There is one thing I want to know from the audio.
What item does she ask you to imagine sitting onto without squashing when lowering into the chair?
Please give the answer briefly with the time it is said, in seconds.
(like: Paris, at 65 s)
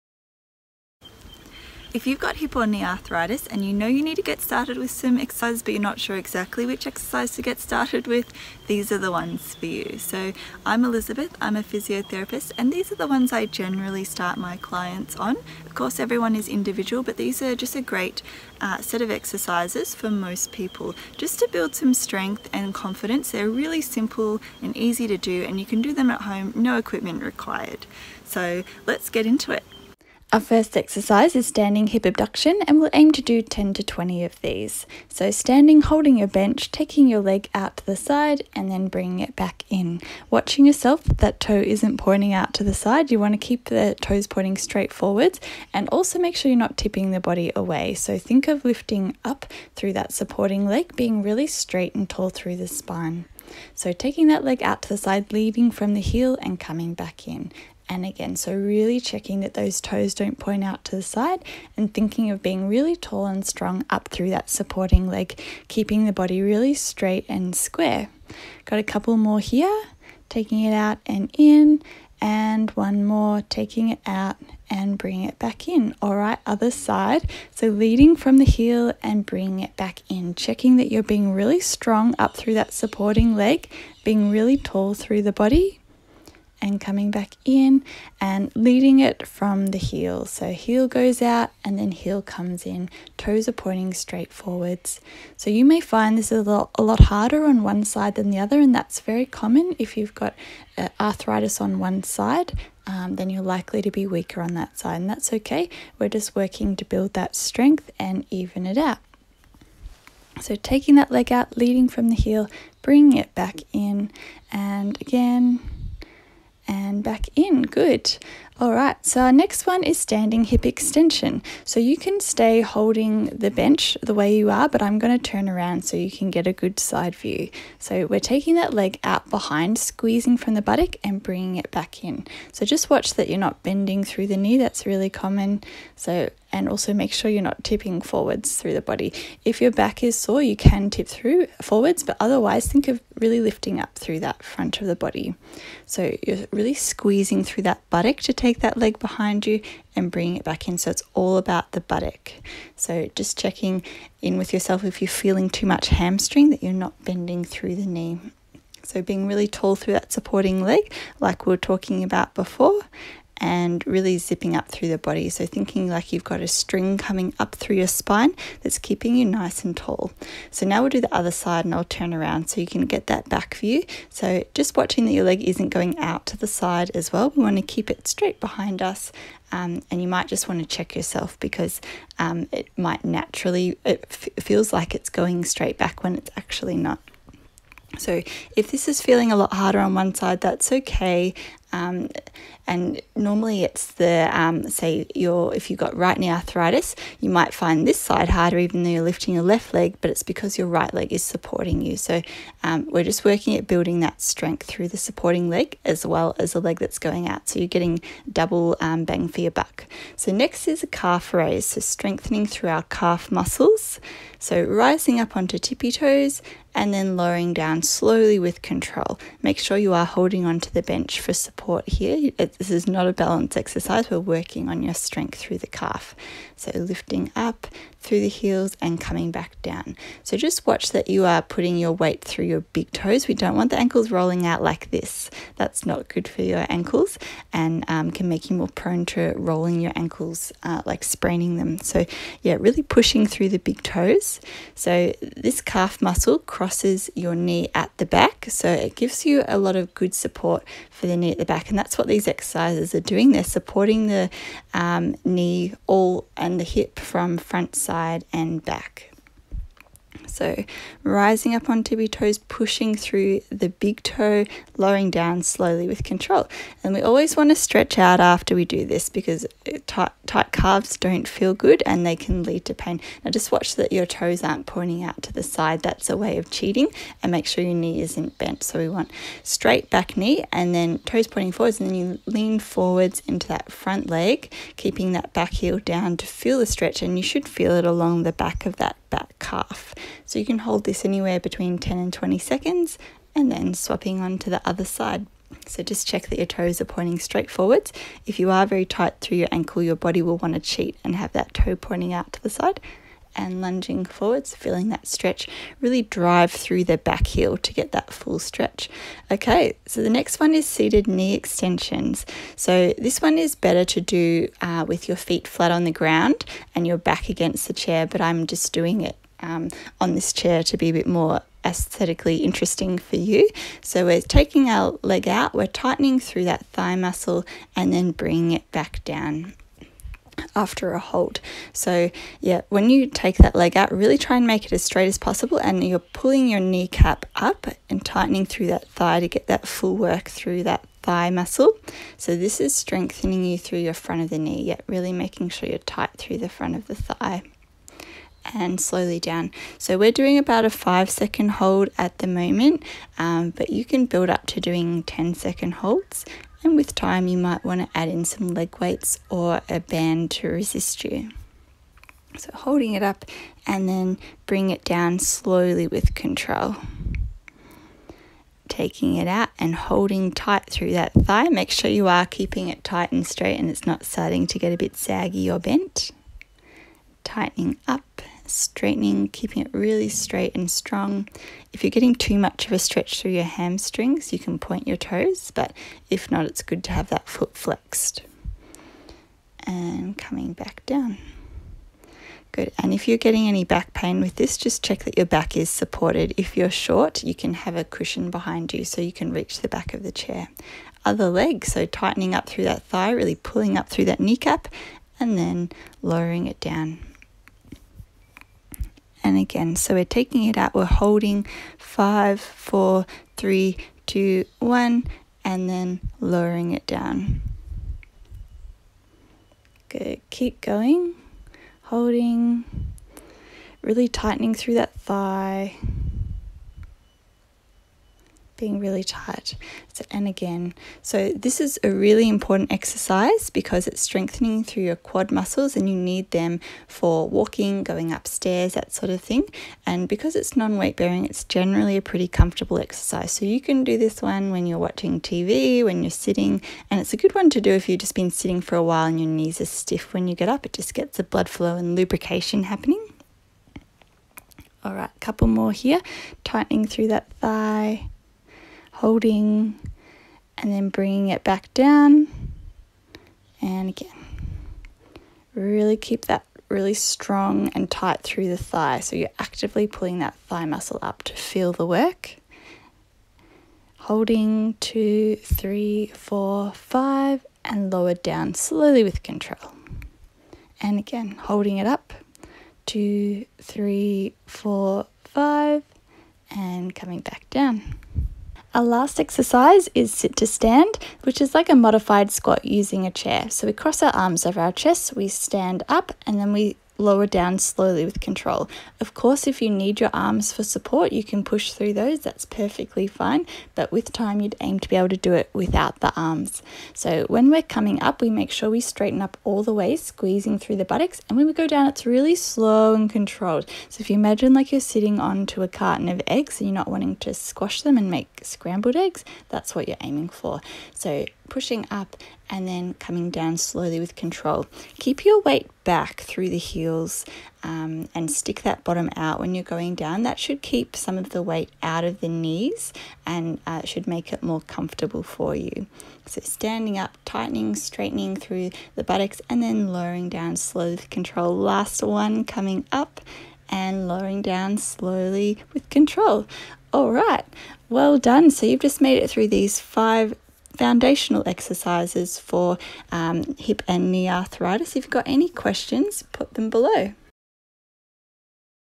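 A carton of eggs, at 515 s.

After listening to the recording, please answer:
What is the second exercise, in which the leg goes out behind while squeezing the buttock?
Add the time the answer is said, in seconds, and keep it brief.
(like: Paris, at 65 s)
Standing hip extension, at 119 s.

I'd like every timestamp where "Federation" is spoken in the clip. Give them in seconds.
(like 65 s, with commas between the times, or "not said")
not said.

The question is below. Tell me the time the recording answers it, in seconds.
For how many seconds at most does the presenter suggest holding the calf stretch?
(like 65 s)
292 s.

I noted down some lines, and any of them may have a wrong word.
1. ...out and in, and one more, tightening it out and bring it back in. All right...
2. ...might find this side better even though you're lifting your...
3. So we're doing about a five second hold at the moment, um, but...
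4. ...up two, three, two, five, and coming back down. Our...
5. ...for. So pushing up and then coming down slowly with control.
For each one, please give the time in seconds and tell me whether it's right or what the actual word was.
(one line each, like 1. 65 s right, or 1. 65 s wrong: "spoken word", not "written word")
1. 70 s wrong: "taking", not "tightening"
2. 197 s wrong: "harder", not "better"
3. 349 s right
4. 481 s wrong: "four", not "two"
5. 520 s right.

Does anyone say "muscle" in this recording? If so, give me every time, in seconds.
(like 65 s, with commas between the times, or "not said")
213 s, 246 s, 326 s, 341 s, 435 s, 470 s.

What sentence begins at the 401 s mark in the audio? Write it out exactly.
Other leg, so tightening up through that thigh, really pulling up through that kneecap, and then lowering it down and again.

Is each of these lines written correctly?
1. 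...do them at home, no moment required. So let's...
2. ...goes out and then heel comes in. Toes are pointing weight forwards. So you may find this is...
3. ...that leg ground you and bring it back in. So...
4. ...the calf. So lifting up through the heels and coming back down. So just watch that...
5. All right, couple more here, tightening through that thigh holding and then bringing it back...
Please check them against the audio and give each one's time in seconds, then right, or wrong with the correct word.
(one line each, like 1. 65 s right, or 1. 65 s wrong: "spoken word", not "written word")
1. 25 s wrong: "equipment", not "moment"
2. 90 s wrong: "straight", not "weight"
3. 148 s wrong: "behind", not "ground"
4. 225 s right
5. 454 s right.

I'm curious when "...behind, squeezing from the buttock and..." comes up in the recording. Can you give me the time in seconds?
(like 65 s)
129 s.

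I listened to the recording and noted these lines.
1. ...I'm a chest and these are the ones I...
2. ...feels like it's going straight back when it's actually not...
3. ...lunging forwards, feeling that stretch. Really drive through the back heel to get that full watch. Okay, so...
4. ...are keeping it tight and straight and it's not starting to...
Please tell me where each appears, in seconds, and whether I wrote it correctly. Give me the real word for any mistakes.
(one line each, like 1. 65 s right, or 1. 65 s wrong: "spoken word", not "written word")
1. 11 s wrong: "physiotherapist", not "chest"
2. 184 s right
3. 303 s wrong: "stretch", not "watch"
4. 372 s right.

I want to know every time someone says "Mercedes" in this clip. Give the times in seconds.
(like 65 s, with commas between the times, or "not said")
not said.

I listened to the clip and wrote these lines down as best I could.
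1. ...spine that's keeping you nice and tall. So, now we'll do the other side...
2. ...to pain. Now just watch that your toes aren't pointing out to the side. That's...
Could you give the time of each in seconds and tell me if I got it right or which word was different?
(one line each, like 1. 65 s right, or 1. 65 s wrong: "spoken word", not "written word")
1. 167 s right
2. 272 s right.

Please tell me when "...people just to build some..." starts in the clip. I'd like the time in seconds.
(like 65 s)
20 s.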